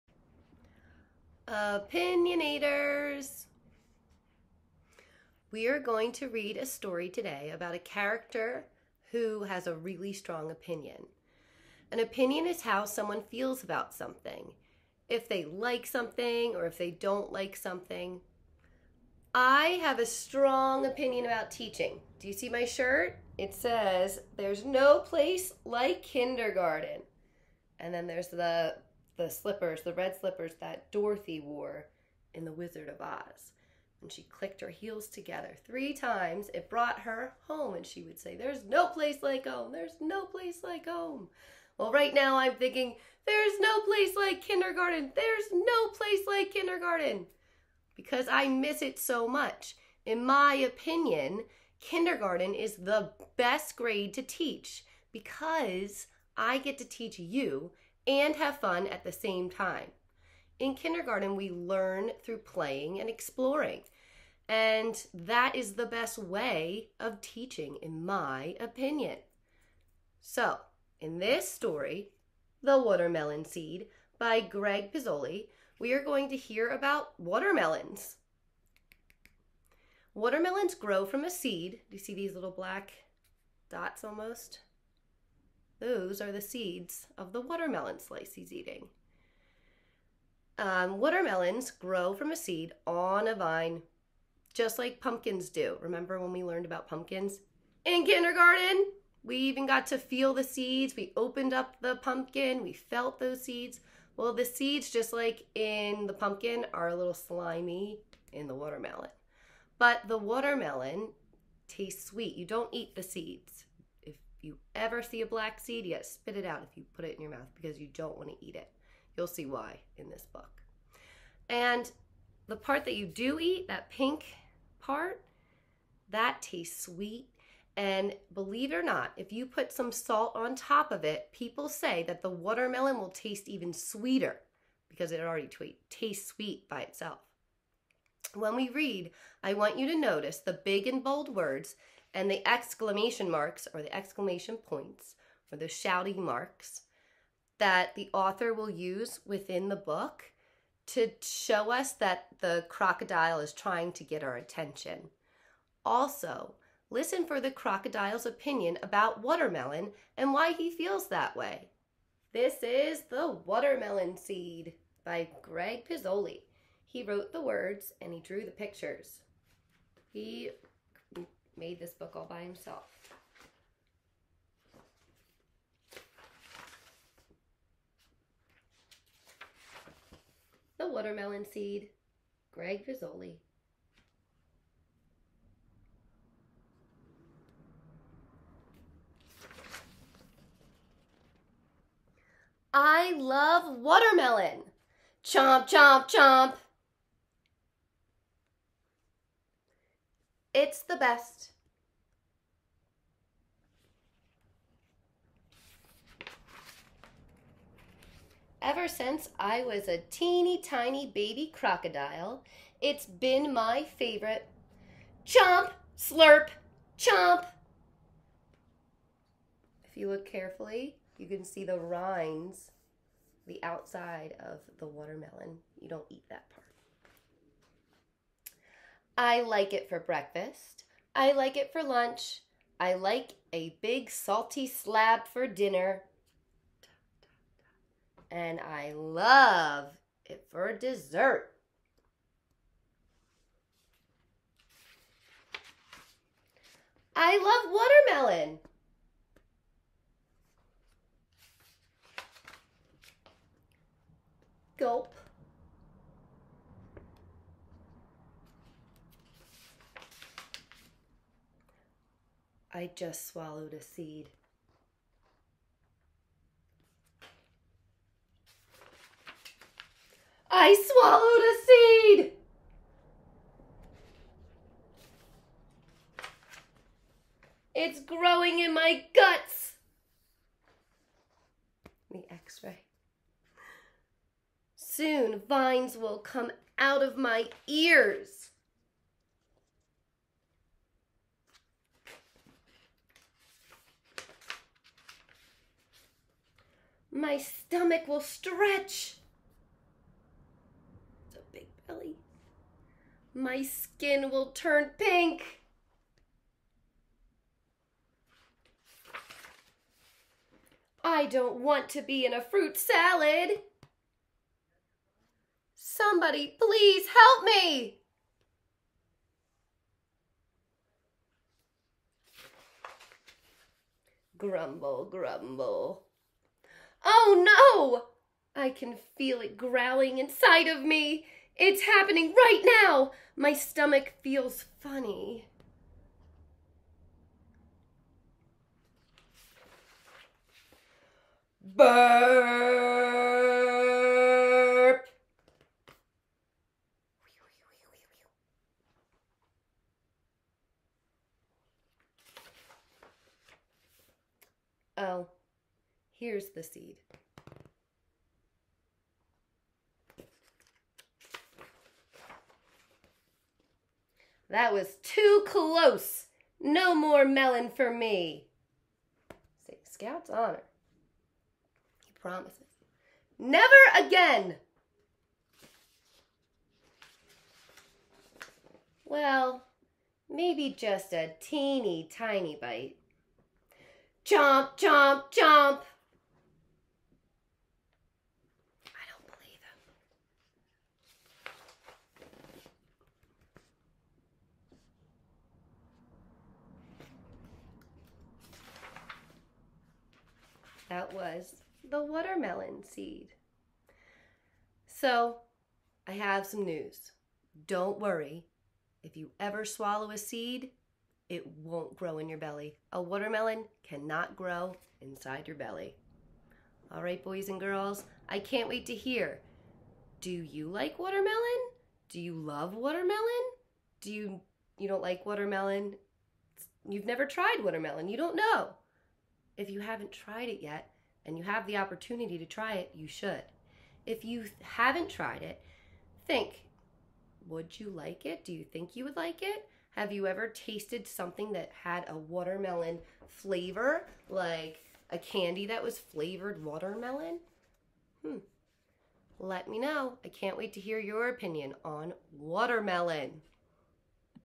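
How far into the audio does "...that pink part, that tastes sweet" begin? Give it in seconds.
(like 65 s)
123 s.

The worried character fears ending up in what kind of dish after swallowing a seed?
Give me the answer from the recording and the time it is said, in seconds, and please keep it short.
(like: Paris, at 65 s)
Fruit salad, at 312 s.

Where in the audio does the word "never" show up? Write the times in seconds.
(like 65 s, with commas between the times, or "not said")
373 s, 427 s.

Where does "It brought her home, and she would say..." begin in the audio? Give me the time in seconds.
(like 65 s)
36 s.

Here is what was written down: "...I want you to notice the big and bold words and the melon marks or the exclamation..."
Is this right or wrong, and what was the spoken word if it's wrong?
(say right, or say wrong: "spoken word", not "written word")
wrong: "exclamation", not "melon".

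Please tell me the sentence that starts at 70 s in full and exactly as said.
So, in this story, The Watermelon Seed by Greg Pizzoli, we are going to hear about watermelons.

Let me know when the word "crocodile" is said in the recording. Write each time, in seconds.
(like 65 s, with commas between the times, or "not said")
152 s, 157 s, 211 s.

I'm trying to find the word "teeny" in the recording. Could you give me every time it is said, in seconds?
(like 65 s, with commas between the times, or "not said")
210 s, 381 s.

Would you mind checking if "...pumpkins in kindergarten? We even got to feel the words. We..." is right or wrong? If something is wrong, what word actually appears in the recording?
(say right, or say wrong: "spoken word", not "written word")
wrong: "seeds", not "words".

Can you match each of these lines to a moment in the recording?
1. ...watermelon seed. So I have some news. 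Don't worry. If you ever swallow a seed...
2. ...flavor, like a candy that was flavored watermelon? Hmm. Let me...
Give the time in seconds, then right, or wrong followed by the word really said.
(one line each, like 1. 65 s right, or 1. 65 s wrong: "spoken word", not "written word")
1. 402 s right
2. 443 s right.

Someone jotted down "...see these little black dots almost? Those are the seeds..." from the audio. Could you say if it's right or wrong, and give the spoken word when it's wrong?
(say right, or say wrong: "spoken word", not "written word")
right.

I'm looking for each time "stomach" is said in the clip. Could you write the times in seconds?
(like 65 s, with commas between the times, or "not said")
297 s, 333 s.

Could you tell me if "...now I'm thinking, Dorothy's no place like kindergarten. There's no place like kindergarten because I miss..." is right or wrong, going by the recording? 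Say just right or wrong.
wrong.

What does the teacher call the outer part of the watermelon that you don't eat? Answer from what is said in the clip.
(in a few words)
Rinds.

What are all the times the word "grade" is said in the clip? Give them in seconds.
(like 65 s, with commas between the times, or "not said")
53 s.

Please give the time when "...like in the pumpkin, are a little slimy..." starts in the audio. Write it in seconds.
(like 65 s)
105 s.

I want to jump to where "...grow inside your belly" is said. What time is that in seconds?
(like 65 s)
414 s.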